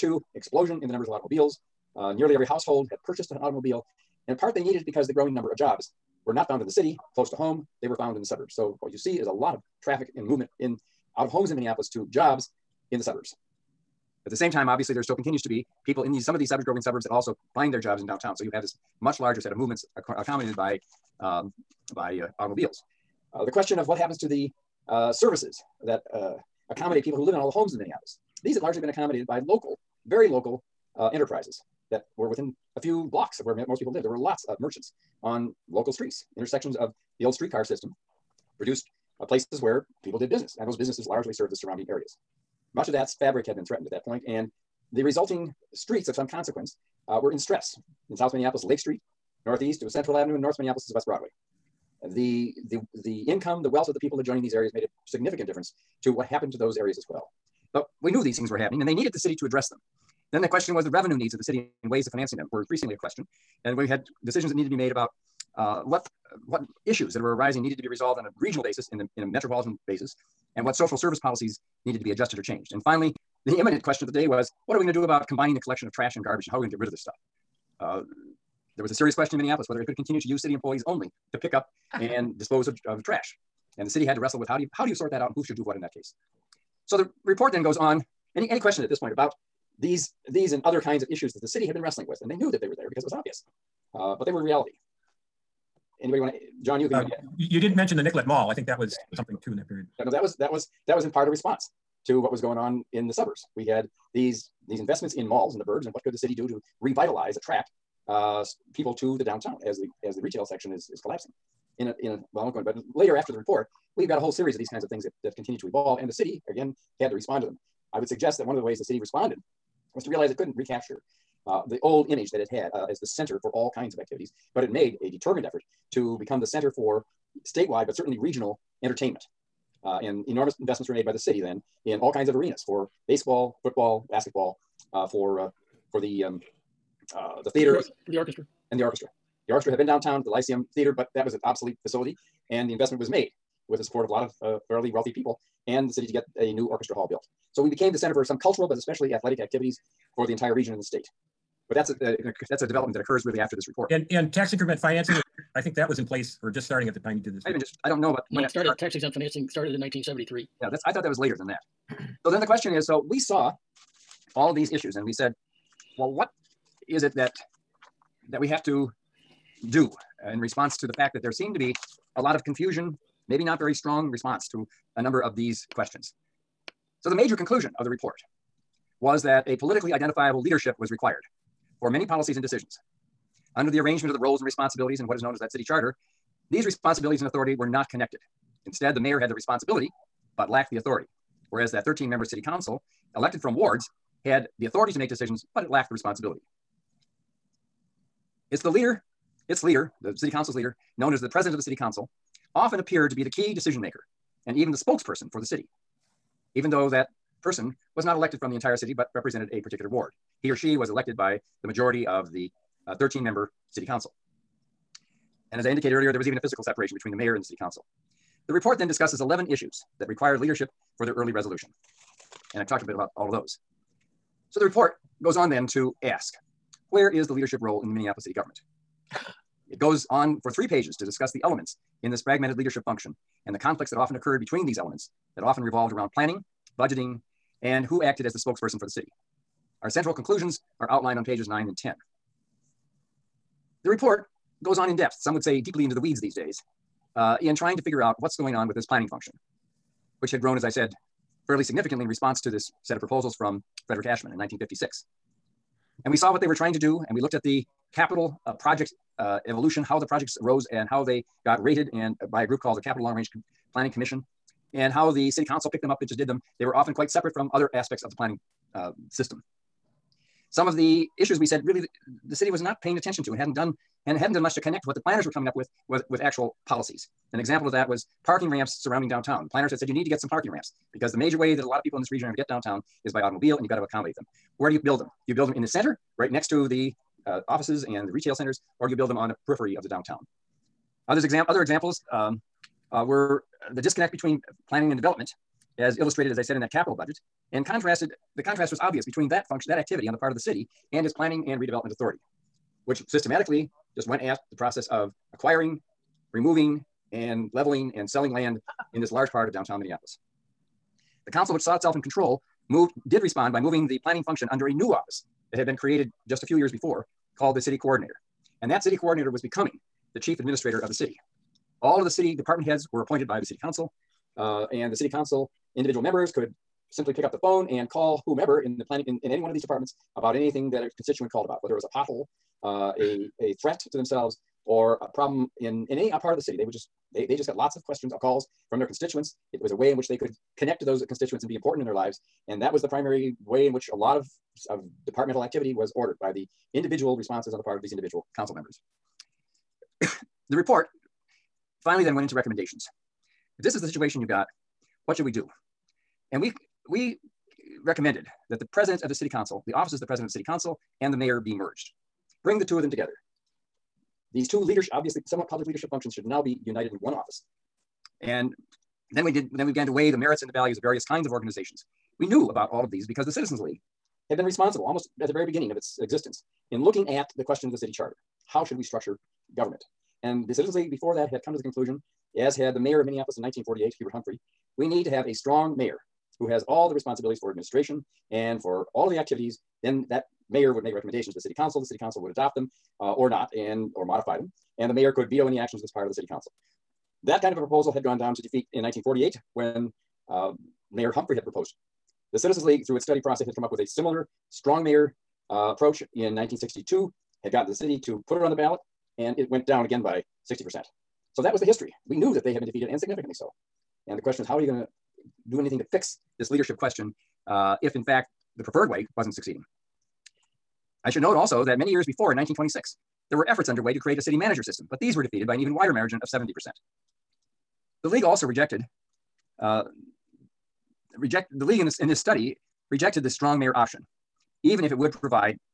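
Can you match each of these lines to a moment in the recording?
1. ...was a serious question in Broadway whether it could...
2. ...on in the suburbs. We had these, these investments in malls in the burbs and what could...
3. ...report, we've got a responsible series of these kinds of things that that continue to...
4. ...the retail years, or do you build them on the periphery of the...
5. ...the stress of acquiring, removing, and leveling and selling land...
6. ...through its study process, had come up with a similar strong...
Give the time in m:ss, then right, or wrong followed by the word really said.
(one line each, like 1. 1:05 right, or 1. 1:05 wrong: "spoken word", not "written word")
1. 1:18 wrong: "Minneapolis", not "Broadway"
2. 1:42 right
3. 1:53 wrong: "whole", not "responsible"
4. 4:48 wrong: "centers", not "years"
5. 5:04 wrong: "process", not "stress"
6. 6:42 right.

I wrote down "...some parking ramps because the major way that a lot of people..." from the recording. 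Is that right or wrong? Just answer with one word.
right.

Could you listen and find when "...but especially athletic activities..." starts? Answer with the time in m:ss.
2:28.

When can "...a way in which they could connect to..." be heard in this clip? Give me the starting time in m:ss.
5:39.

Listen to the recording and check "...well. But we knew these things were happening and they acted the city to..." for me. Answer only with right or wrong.
wrong.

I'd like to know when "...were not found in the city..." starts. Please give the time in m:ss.
0:06.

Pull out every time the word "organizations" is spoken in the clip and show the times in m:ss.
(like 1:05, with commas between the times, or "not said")
6:11.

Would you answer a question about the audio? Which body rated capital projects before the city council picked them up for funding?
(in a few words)
Capital Long Range Planning Commission.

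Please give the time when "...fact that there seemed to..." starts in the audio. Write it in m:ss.
2:50.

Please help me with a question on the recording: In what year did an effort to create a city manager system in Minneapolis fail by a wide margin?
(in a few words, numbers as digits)
1926.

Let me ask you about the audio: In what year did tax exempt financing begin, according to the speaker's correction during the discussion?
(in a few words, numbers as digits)
1973.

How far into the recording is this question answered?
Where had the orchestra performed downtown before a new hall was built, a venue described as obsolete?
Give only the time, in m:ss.
2:20.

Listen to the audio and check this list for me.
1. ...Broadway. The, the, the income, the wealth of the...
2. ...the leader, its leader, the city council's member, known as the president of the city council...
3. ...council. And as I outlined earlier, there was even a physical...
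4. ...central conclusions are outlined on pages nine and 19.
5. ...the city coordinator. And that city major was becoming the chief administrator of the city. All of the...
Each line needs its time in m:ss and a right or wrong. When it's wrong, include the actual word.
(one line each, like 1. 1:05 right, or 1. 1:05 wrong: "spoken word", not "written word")
1. 0:51 right
2. 3:18 wrong: "leader", not "member"
3. 3:33 wrong: "indicated", not "outlined"
4. 3:59 wrong: "10", not "19"
5. 5:17 wrong: "coordinator", not "major".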